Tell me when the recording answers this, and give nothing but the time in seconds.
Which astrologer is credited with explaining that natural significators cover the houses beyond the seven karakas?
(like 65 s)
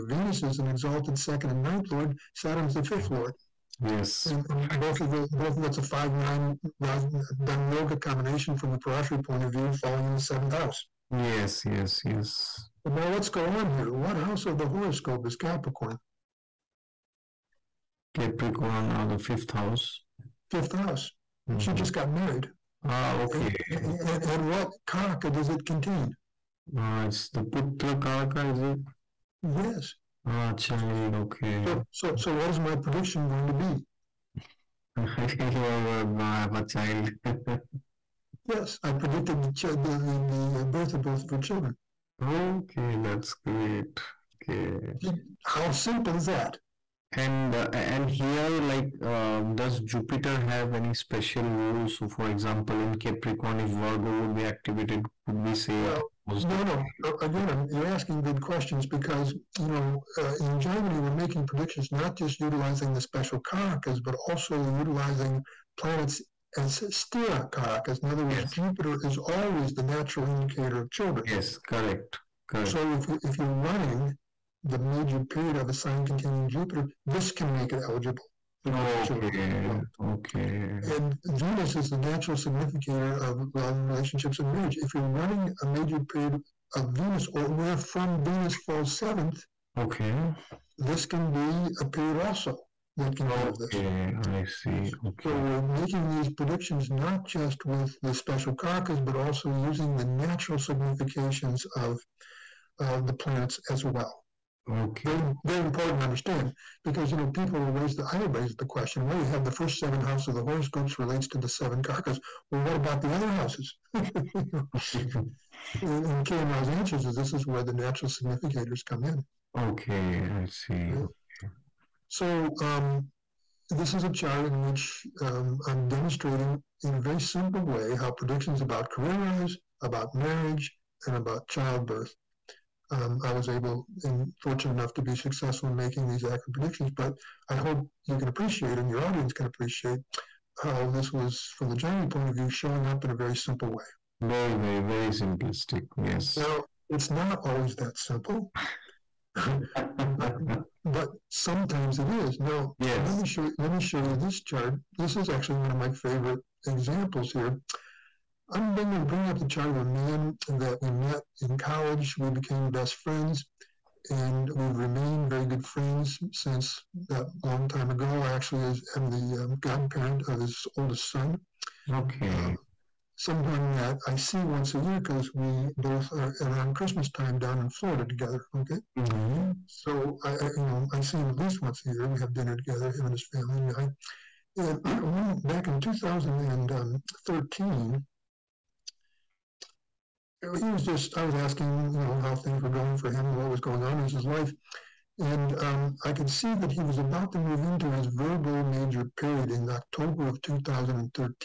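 116 s.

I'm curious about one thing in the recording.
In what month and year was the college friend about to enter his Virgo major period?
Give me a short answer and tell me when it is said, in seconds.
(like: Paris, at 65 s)
October 2013, at 199 s.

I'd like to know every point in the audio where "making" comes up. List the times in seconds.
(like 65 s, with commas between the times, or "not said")
61 s, 95 s, 135 s.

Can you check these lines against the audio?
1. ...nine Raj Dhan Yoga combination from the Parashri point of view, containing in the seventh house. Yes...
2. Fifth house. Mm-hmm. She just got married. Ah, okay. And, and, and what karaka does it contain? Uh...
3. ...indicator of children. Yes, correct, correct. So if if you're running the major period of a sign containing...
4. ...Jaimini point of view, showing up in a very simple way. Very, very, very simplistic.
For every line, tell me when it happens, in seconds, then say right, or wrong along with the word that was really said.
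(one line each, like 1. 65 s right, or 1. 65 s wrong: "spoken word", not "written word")
1. 6 s wrong: "falling", not "containing"
2. 20 s right
3. 70 s right
4. 141 s right.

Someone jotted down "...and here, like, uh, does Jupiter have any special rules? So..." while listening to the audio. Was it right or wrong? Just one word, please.
right.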